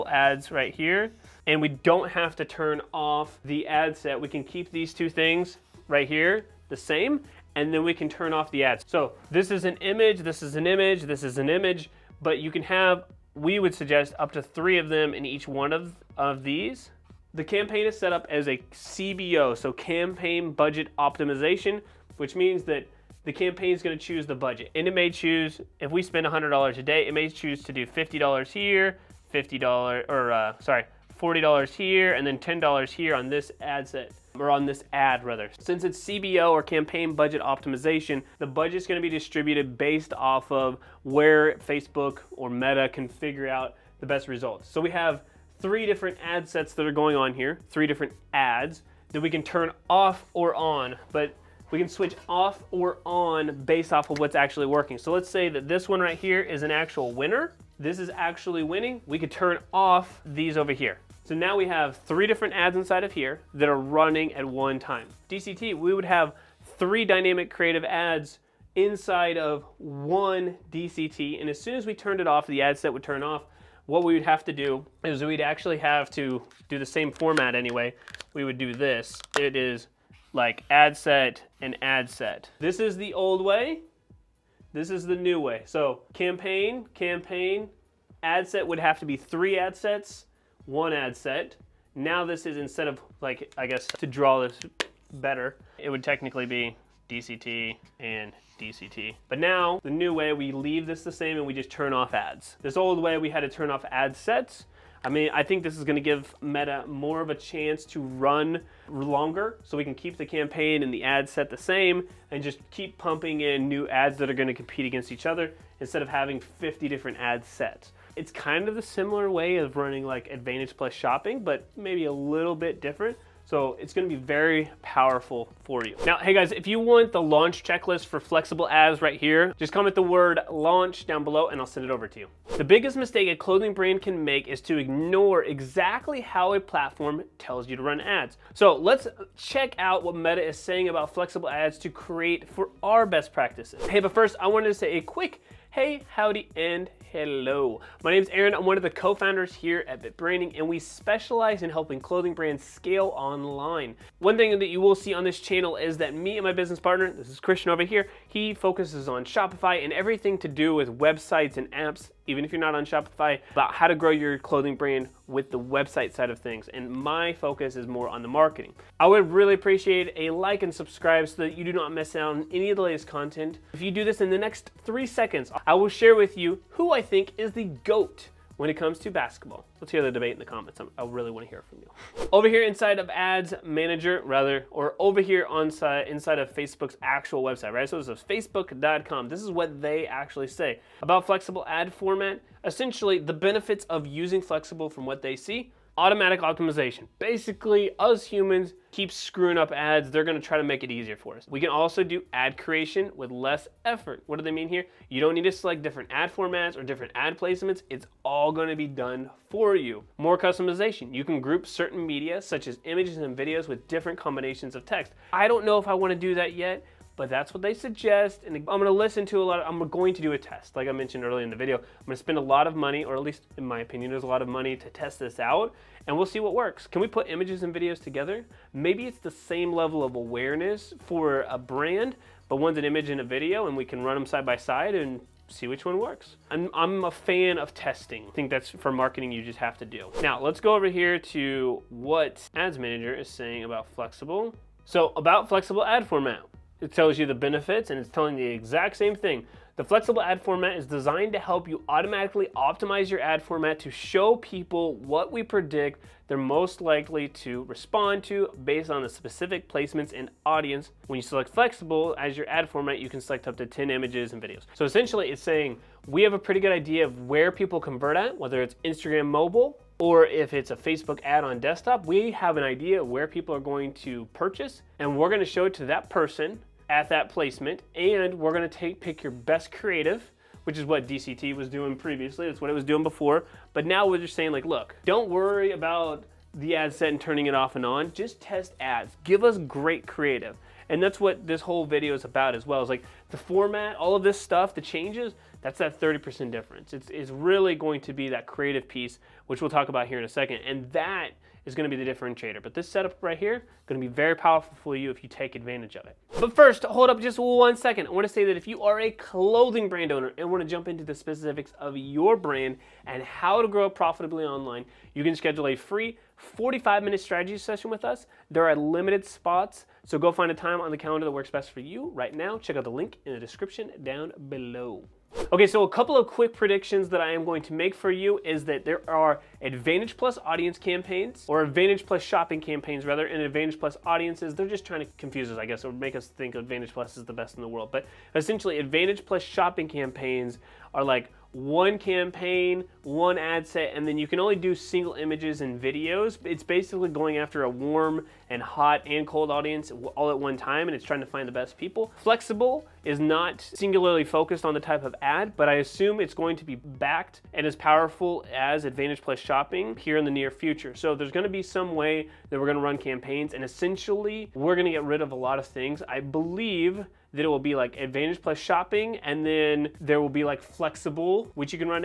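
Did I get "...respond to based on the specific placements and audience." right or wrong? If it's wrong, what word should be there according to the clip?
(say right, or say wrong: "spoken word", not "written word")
right.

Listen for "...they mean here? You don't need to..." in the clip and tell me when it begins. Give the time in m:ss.
3:24.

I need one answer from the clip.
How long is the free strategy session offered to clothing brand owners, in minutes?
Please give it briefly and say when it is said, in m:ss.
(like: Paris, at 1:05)
45 minutes, at 5:16.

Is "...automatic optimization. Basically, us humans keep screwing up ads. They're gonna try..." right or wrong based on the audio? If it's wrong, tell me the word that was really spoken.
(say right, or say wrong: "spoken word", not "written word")
right.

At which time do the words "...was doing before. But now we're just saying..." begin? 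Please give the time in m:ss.
4:42.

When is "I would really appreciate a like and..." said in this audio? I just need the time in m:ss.
2:48.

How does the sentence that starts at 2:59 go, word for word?
Let's hear the debate in the comments.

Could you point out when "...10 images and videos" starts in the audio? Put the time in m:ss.
4:23.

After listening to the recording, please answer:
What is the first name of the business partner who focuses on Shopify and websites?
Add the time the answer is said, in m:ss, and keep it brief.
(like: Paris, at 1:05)
Christian, at 2:37.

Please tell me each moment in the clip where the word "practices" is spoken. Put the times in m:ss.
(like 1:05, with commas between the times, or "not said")
2:23.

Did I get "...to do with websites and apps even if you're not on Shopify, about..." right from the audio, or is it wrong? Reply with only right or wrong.
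right.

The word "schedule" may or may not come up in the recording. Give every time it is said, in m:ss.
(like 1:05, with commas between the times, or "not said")
5:15.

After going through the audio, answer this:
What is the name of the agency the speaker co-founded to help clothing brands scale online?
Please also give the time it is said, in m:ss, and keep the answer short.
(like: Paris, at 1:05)
BitBranding, at 2:30.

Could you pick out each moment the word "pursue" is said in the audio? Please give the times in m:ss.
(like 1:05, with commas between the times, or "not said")
not said.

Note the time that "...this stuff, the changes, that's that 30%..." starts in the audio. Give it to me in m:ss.
4:54.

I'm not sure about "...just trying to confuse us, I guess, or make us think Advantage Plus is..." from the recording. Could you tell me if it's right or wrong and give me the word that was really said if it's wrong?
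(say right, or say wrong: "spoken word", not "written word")
right.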